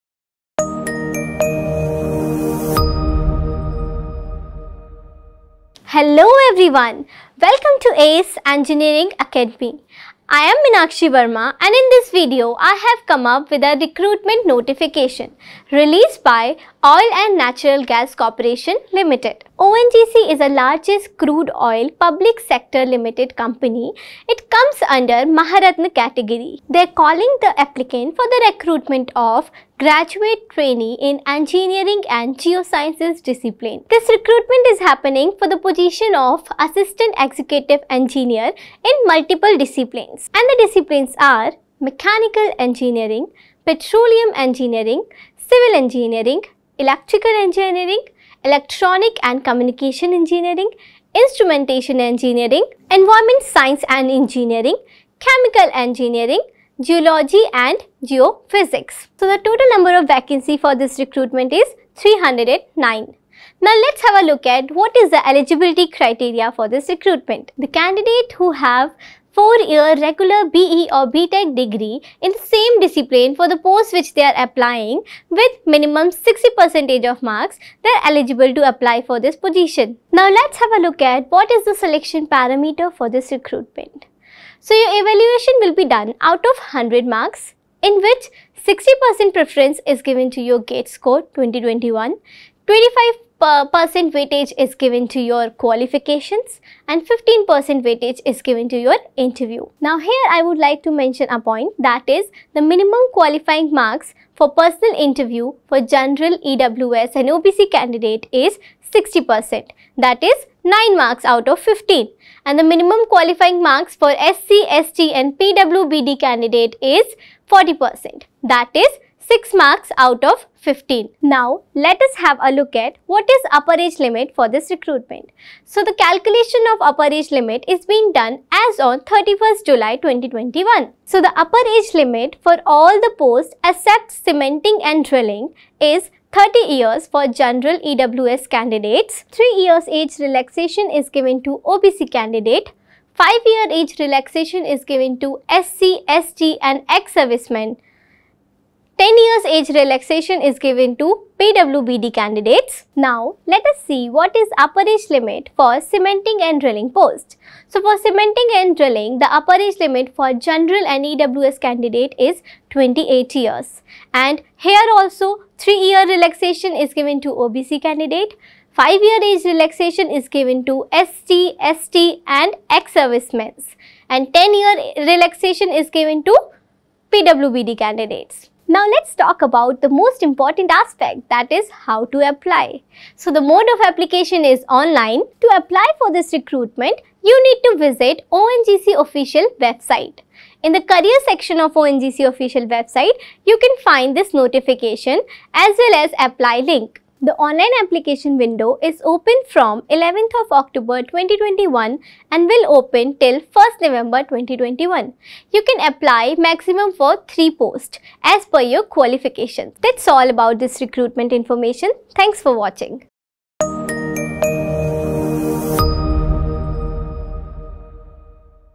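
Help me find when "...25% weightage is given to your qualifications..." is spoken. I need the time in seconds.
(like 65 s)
92 s.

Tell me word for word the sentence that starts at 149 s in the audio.
10 years age relaxation is given to PWBD candidates.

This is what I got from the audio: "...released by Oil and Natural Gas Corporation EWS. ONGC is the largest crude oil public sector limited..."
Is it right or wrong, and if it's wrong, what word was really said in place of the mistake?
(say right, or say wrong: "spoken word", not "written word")
wrong: "Limited", not "EWS".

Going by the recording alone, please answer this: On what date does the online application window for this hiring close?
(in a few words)
1st November 2021.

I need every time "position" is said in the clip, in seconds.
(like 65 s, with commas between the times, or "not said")
35 s, 79 s.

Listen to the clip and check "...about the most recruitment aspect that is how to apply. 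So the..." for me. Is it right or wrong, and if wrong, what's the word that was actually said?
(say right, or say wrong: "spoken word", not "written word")
wrong: "important", not "recruitment".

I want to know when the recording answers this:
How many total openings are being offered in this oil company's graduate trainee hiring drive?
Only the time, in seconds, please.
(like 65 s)
61 s.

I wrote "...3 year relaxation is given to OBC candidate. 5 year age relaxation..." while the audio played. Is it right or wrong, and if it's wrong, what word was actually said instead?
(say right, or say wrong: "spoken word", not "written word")
right.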